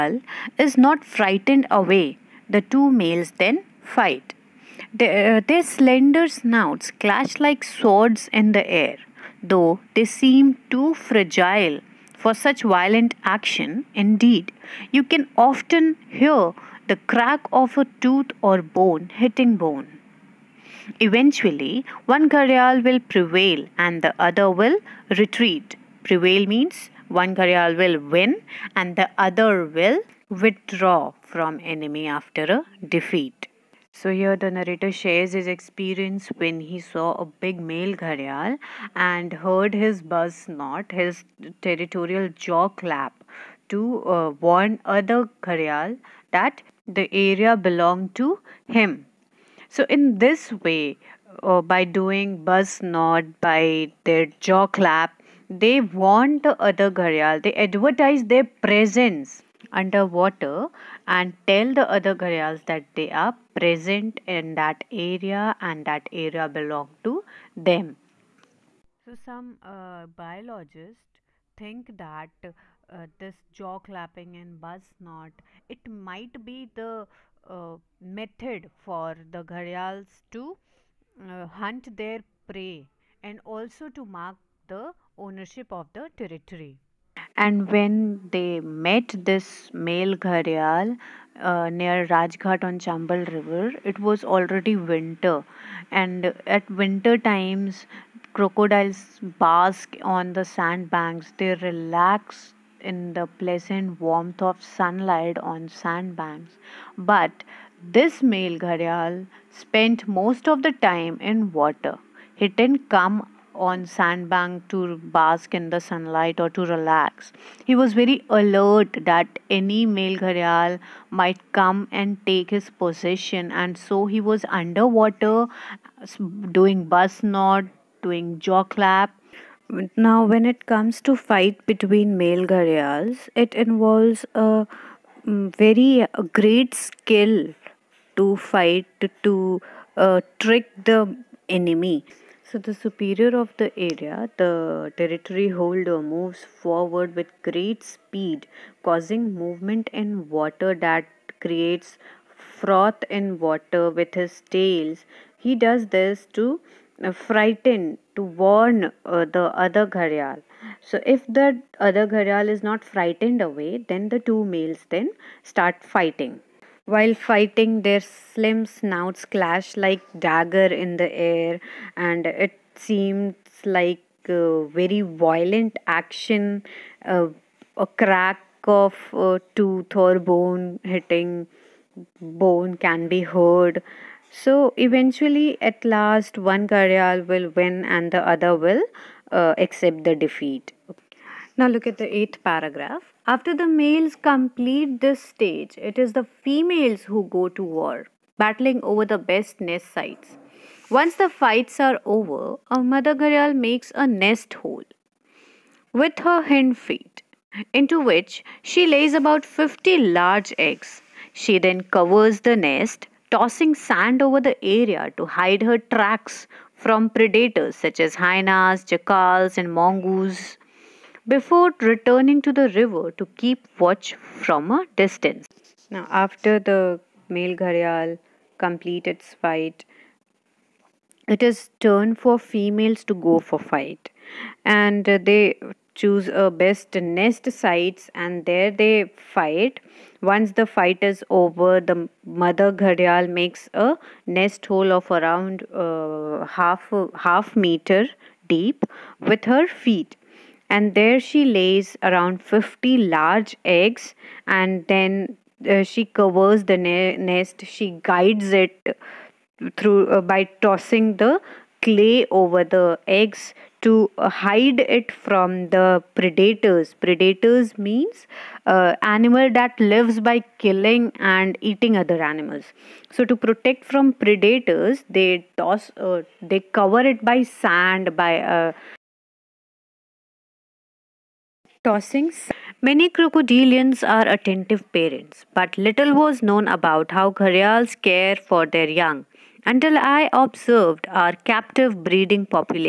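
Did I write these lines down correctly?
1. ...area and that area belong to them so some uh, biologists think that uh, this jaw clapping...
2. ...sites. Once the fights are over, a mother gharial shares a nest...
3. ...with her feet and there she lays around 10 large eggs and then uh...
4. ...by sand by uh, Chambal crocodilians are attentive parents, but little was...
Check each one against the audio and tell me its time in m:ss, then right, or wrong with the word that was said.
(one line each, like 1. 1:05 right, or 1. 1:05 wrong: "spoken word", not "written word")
1. 1:04 right
2. 3:19 wrong: "makes", not "shares"
3. 4:09 wrong: "50", not "10"
4. 4:37 wrong: "Many", not "Chambal".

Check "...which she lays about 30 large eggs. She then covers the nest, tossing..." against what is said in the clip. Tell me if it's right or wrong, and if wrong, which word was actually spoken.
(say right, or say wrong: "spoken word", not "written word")
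wrong: "50", not "30".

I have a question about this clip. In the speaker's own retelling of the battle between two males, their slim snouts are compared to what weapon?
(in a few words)
dagger.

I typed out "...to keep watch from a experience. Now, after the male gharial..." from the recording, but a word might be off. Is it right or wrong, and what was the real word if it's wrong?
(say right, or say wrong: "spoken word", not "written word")
wrong: "distance", not "experience".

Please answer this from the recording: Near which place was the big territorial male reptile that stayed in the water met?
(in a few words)
Rajghat.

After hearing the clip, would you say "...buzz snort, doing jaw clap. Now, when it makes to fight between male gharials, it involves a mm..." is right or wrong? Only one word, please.
wrong.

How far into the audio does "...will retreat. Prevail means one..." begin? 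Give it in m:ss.
0:24.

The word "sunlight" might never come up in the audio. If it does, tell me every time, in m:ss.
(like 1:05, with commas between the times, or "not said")
1:44, 1:55.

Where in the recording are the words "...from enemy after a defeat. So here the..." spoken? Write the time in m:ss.
0:31.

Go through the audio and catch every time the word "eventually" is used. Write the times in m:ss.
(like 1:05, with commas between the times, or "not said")
0:21, 3:04.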